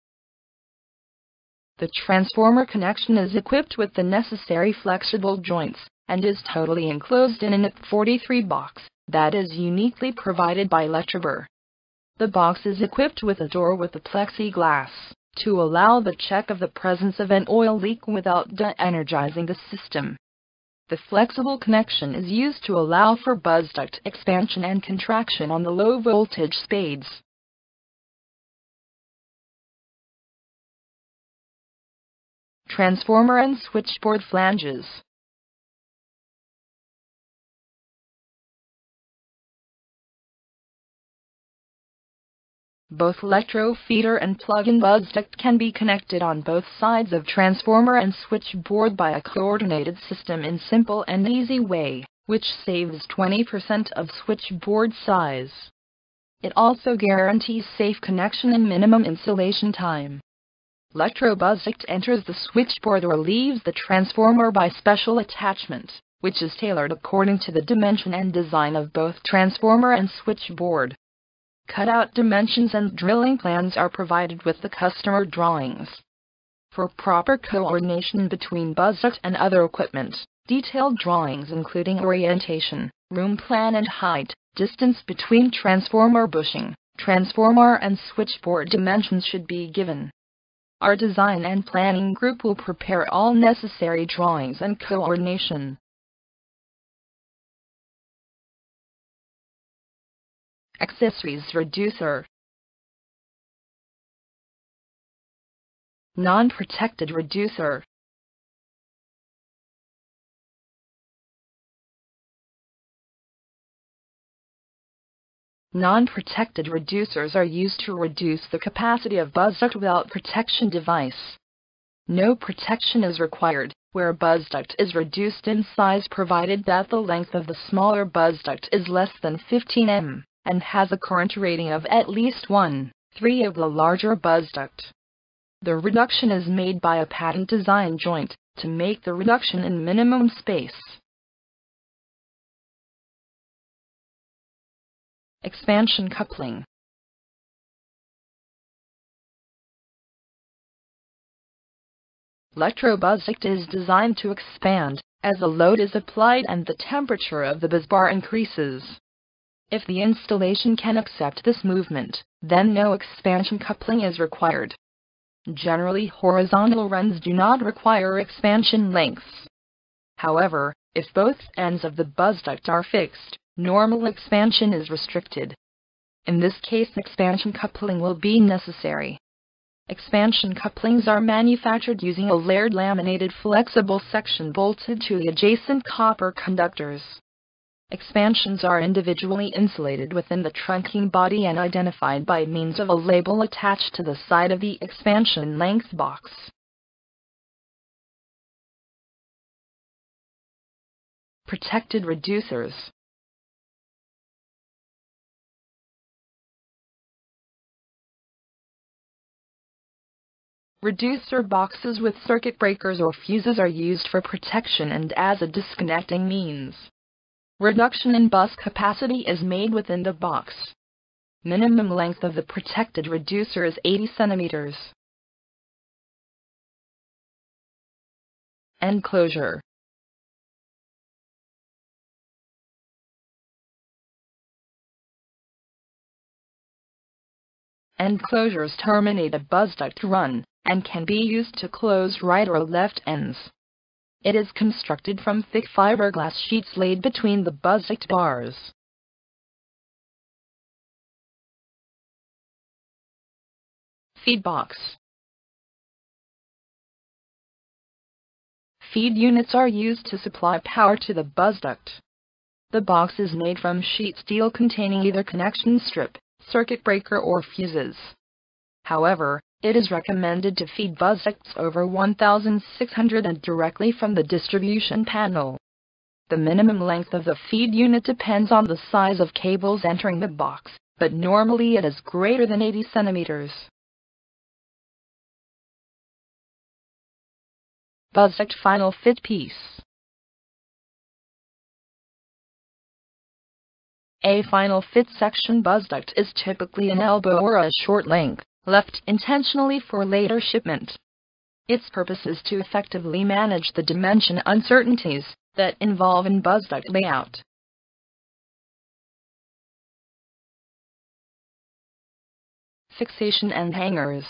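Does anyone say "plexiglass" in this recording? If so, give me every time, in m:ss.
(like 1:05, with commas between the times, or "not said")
0:13.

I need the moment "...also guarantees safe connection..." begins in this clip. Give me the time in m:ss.
0:56.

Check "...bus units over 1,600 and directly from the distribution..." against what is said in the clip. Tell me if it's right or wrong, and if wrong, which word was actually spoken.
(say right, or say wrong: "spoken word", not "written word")
wrong: "ducts", not "units".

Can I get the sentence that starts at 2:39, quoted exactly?
If the installation can accept this movement, then no expansion coupling is required.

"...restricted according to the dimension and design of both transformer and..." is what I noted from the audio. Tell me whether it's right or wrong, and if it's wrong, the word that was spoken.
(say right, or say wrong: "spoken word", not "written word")
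wrong: "tailored", not "restricted".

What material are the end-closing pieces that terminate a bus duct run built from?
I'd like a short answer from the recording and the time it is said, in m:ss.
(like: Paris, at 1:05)
fiberglass sheets, at 4:05.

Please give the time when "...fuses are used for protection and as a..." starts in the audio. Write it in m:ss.
3:33.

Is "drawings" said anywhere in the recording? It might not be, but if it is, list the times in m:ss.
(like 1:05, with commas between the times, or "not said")
1:15, 1:20, 1:34.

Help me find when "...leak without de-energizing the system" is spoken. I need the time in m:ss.
0:17.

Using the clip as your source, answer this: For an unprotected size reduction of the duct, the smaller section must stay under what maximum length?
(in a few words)
15 m.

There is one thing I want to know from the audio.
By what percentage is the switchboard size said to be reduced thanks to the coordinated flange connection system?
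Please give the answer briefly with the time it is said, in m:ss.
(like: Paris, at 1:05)
20%, at 0:53.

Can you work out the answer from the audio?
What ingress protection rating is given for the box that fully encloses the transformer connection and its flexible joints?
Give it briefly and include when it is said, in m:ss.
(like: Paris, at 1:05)
IP43, at 0:07.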